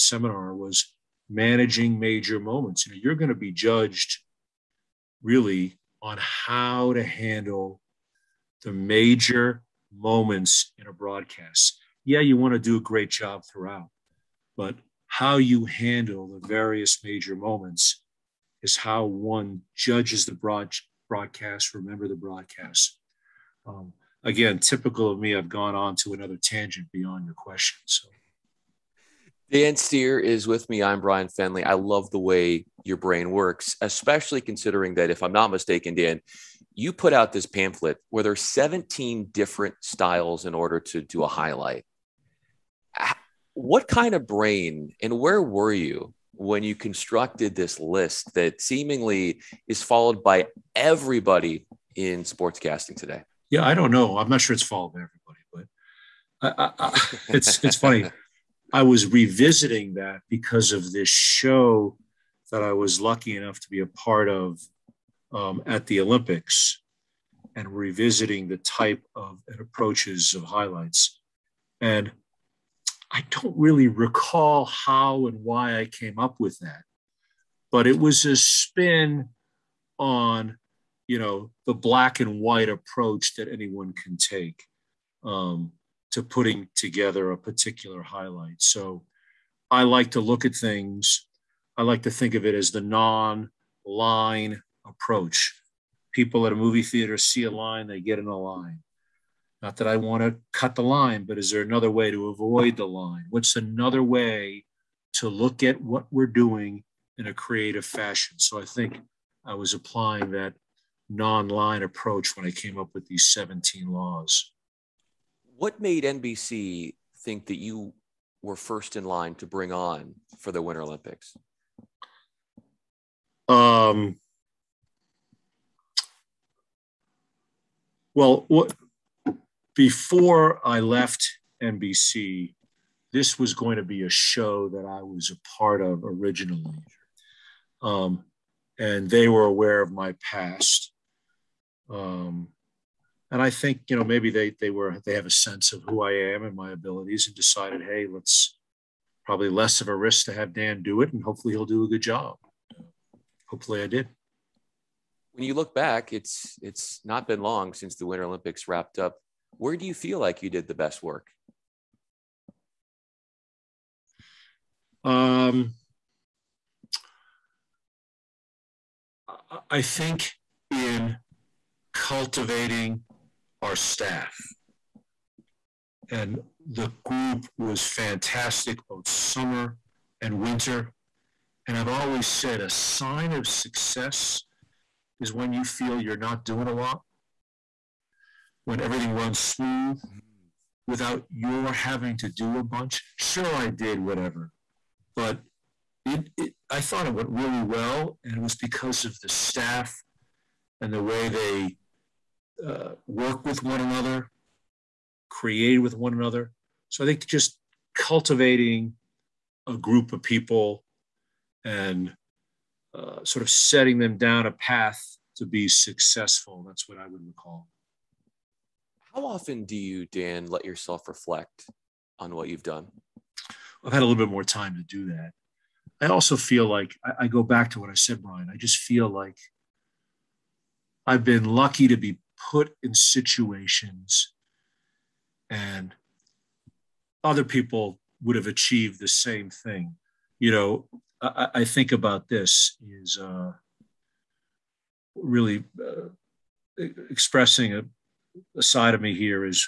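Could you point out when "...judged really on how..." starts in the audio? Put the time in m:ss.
0:03.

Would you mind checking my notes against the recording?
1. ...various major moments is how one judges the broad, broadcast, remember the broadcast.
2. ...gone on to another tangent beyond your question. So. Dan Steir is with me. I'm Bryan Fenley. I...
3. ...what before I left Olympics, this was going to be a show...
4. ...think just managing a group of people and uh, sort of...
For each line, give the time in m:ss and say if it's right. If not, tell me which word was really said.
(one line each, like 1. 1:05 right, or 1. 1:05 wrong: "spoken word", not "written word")
1. 0:16 right
2. 0:25 right
3. 2:08 wrong: "NBC", not "Olympics"
4. 3:27 wrong: "cultivating", not "managing".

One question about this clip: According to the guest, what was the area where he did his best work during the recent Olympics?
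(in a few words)
cultivating our staff.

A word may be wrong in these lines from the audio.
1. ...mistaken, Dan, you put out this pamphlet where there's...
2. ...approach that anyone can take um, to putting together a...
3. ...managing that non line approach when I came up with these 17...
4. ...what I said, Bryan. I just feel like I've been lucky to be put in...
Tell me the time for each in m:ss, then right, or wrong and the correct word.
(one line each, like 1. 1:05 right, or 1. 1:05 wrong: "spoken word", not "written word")
1. 0:35 right
2. 1:22 right
3. 1:49 wrong: "applying", not "managing"
4. 3:47 right.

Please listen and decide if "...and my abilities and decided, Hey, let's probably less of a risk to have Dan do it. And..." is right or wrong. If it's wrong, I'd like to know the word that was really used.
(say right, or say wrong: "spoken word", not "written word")
right.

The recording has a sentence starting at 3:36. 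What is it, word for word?
That's what I would recall how often do you, Dan, let yourself reflect on what you've done?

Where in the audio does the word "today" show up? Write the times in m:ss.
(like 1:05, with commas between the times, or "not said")
0:52.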